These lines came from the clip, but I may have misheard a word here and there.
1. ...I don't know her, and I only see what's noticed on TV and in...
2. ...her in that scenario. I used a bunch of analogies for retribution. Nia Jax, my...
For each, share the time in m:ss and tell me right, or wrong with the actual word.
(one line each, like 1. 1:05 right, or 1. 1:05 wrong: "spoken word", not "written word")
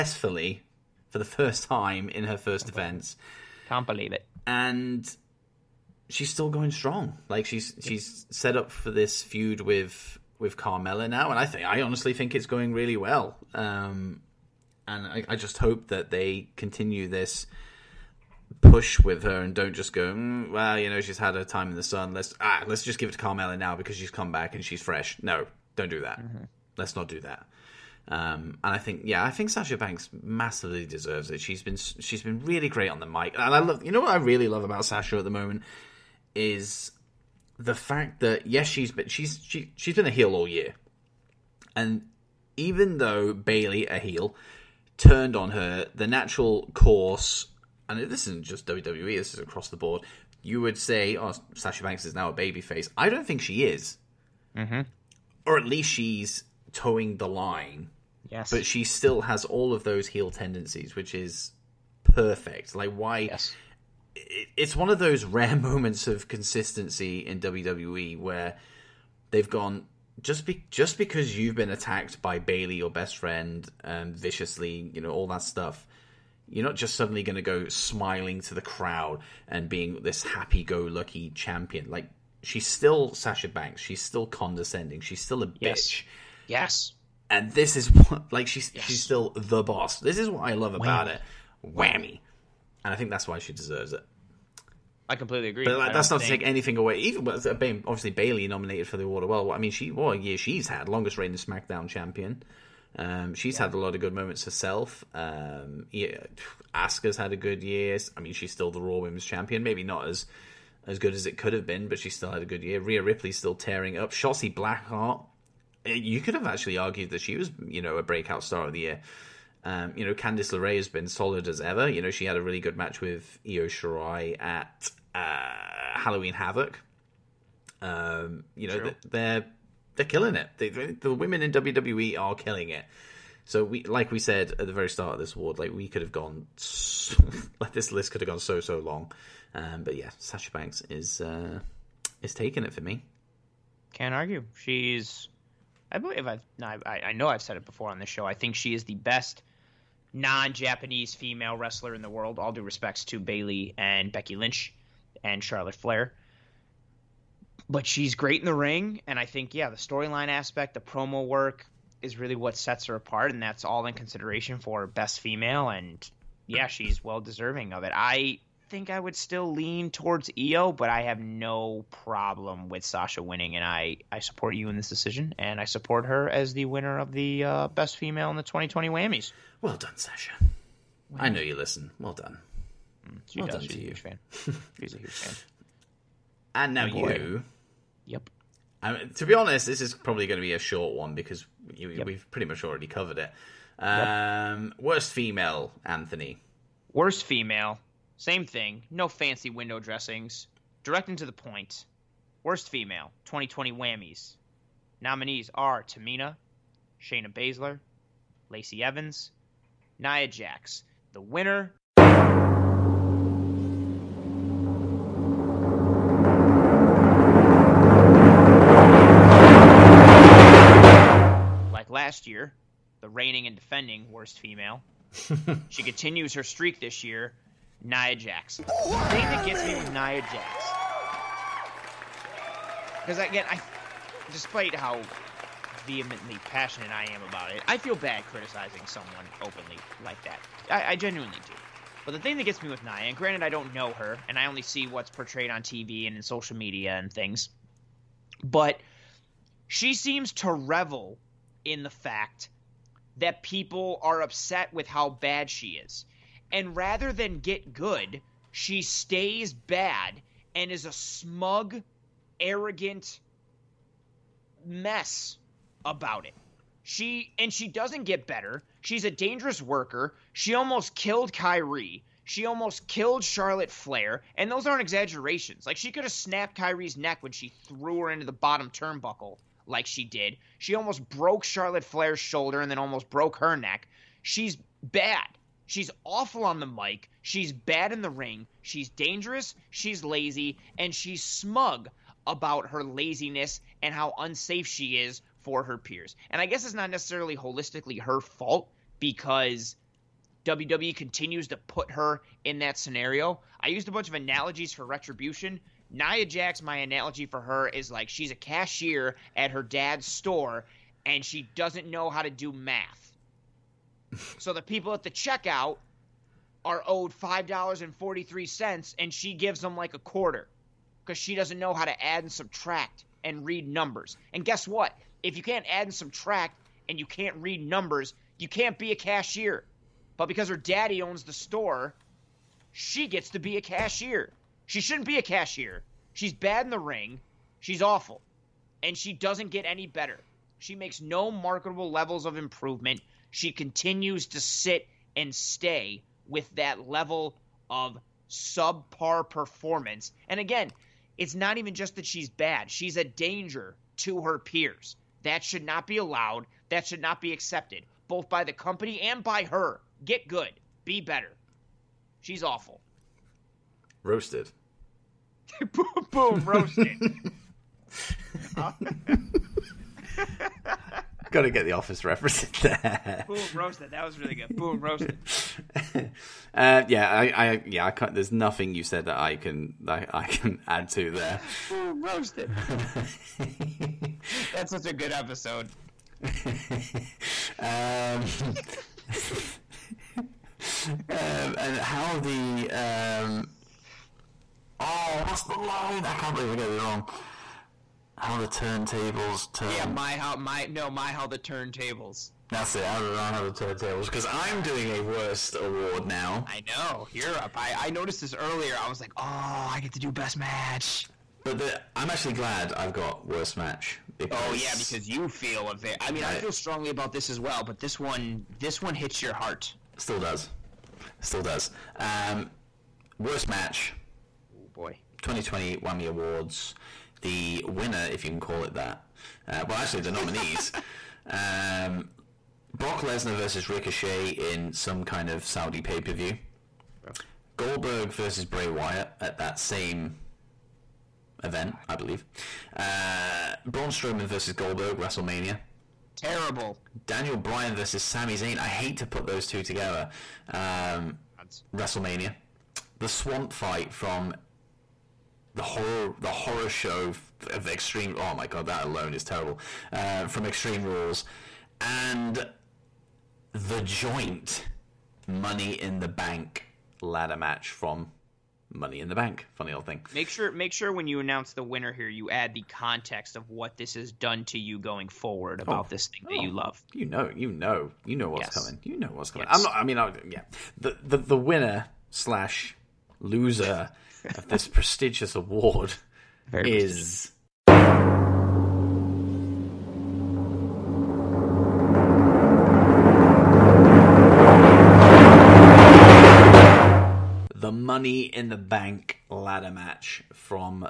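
1. 4:03 wrong: "portrayed", not "noticed"
2. 5:01 right.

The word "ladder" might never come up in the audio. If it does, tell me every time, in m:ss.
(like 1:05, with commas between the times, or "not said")
7:47, 8:19.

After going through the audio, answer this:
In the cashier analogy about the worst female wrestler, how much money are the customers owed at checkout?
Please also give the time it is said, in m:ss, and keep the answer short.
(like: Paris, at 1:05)
$5.43, at 5:17.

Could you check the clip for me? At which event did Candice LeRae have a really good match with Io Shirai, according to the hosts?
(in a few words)
Halloween Havoc.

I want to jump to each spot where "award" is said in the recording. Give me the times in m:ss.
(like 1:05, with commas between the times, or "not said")
1:39, 2:15, 6:45, 7:06, 8:05.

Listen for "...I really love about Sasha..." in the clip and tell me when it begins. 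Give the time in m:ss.
0:34.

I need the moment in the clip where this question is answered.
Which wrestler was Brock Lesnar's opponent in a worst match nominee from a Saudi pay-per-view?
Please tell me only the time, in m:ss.
7:13.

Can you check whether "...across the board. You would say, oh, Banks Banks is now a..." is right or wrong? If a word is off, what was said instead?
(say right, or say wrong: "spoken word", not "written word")
wrong: "Sasha", not "Banks".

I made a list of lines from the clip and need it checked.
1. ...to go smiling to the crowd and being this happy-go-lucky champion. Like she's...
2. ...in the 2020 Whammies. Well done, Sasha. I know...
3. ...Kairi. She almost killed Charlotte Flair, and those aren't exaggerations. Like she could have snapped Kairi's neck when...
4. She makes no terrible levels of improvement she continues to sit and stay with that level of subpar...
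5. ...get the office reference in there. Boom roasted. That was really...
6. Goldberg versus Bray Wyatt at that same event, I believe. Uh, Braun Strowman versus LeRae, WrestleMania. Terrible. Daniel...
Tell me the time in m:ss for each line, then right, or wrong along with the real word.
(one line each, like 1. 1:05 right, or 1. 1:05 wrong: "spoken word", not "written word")
1. 1:17 right
2. 2:58 right
3. 4:31 right
4. 5:40 wrong: "marketable", not "terrible"
5. 6:11 right
6. 7:17 wrong: "Goldberg", not "LeRae".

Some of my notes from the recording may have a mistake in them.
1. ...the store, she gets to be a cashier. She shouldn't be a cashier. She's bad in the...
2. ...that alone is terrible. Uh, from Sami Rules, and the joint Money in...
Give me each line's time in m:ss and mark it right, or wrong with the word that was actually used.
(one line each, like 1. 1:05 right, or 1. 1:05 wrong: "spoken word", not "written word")
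1. 5:31 right
2. 7:38 wrong: "Extreme", not "Sami".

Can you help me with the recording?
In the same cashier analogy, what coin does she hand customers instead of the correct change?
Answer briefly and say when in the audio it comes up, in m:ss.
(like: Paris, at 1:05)
A quarter, at 5:19.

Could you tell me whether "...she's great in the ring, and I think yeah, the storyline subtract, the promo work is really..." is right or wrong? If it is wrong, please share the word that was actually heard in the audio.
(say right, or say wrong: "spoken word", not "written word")
wrong: "aspect", not "subtract".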